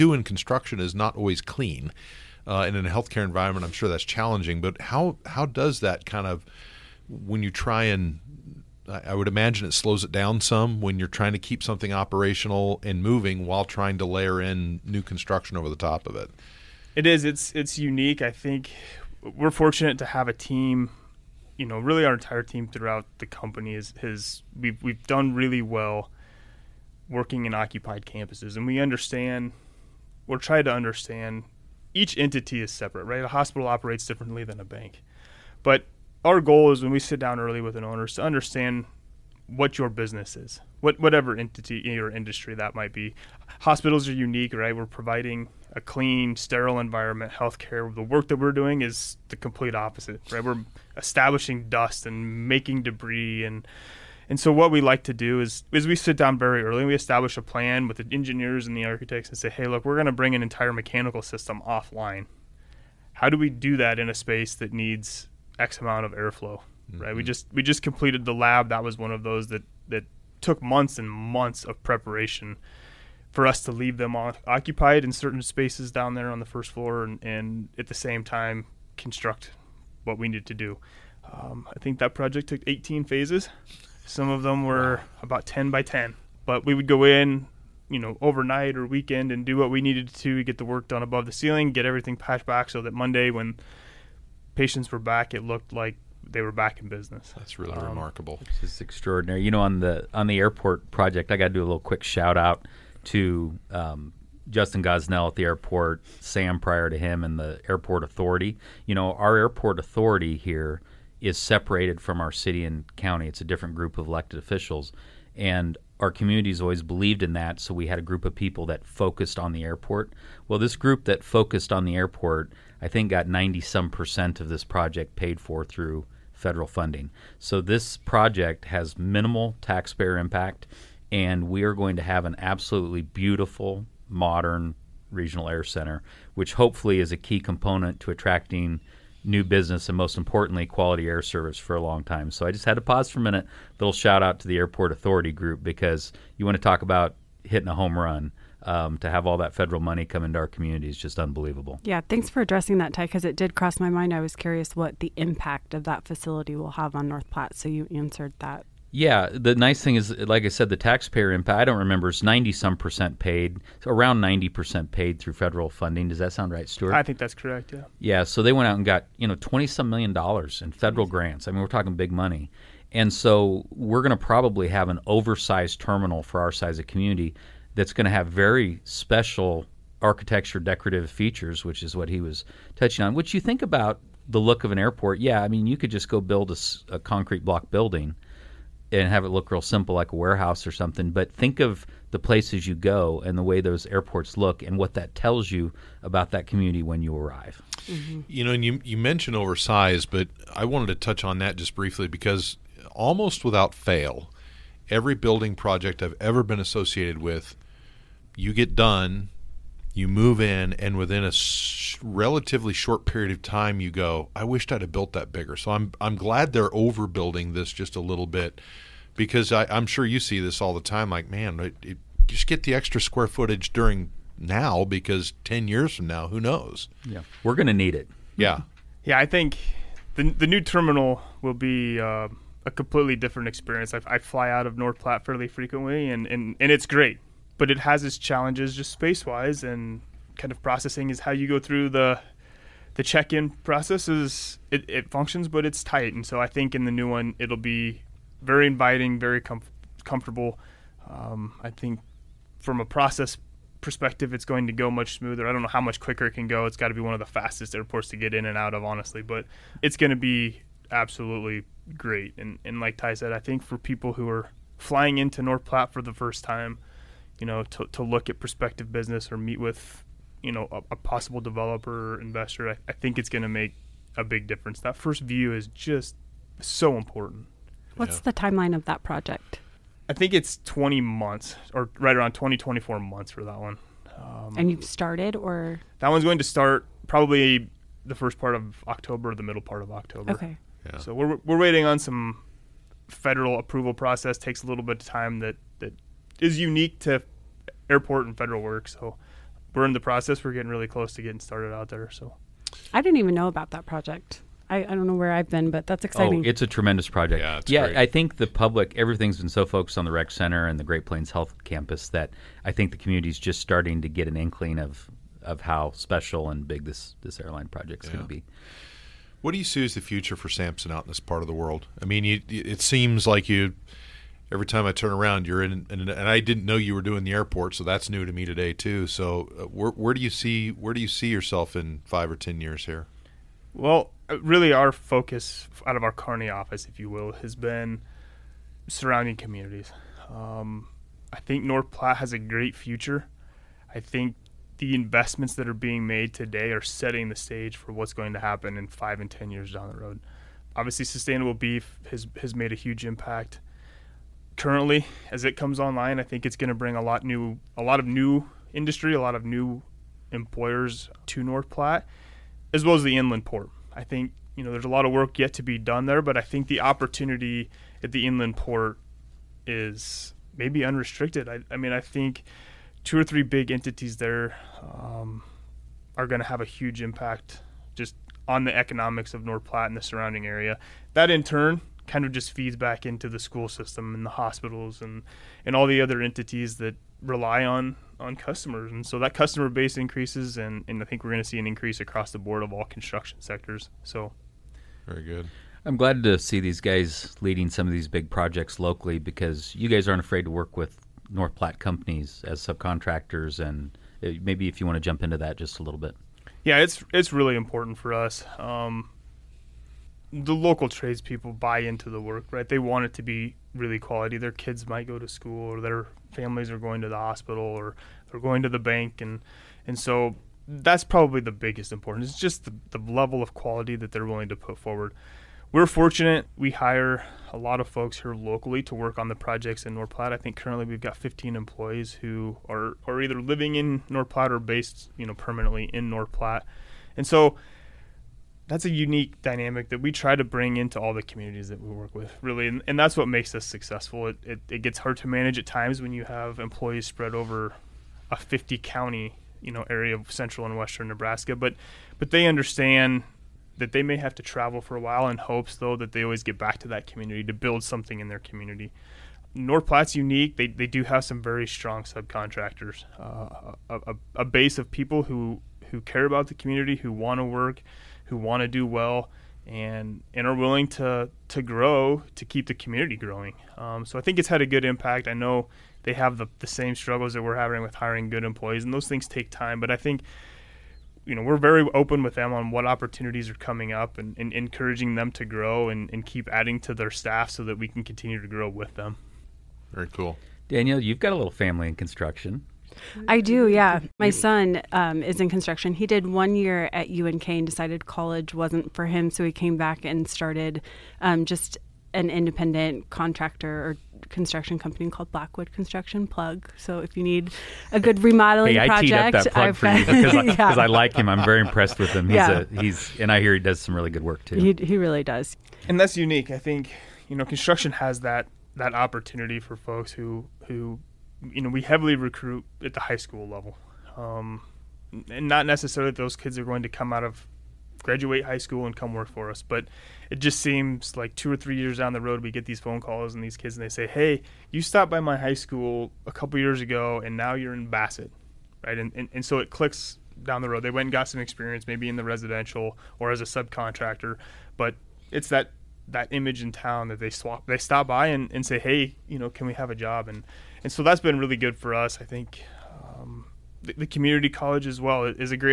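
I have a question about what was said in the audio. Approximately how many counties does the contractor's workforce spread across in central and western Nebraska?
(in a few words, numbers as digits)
50.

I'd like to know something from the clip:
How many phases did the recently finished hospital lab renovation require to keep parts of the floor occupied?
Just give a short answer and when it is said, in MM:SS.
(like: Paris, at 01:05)
18, at 01:22.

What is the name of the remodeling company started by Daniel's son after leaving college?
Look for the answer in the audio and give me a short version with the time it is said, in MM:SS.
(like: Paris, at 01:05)
Blackwood Construction, at 08:25.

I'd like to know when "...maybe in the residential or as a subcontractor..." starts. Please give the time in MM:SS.
09:01.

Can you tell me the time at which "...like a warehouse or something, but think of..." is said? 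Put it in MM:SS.
03:09.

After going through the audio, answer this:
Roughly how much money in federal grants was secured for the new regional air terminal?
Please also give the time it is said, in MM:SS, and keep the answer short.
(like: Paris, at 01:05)
twenty some million dollars, at 02:49.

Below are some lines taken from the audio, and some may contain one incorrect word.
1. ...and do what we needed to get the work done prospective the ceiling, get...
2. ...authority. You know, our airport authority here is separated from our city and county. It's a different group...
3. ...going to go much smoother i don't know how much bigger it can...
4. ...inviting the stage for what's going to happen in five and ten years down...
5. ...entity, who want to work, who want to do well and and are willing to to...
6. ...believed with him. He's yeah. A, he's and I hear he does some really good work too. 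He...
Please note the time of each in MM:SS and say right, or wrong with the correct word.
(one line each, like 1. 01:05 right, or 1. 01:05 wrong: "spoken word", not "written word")
1. 01:29 wrong: "above", not "prospective"
2. 01:48 right
3. 04:14 wrong: "quicker", not "bigger"
4. 05:46 wrong: "setting", not "inviting"
5. 07:46 wrong: "community", not "entity"
6. 08:31 wrong: "impressed", not "believed".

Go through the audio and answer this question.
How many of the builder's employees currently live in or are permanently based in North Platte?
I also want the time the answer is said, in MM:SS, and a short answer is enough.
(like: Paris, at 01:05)
15, at 07:11.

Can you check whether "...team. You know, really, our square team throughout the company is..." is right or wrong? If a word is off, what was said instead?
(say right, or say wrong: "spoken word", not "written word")
wrong: "entire", not "square".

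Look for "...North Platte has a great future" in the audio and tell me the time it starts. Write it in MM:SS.
05:41.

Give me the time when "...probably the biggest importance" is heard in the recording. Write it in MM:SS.
07:01.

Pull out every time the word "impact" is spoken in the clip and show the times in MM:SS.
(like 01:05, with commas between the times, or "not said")
02:10, 02:35, 02:41, 05:53, 06:17, 07:54.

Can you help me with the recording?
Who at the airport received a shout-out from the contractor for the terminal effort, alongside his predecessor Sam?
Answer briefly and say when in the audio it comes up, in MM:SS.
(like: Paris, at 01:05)
Justin Gosnell, at 01:44.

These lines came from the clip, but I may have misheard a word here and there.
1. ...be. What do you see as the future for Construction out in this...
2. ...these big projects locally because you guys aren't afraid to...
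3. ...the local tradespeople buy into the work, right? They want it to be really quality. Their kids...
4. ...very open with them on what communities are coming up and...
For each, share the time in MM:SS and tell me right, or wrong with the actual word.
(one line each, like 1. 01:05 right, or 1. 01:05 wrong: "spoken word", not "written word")
1. 05:18 wrong: "Sampson", not "Construction"
2. 06:37 right
3. 06:50 right
4. 08:01 wrong: "opportunities", not "communities".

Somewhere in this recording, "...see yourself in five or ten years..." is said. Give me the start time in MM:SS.
05:31.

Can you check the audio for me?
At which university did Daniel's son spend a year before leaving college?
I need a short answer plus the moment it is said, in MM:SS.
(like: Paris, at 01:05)
UNK, at 08:17.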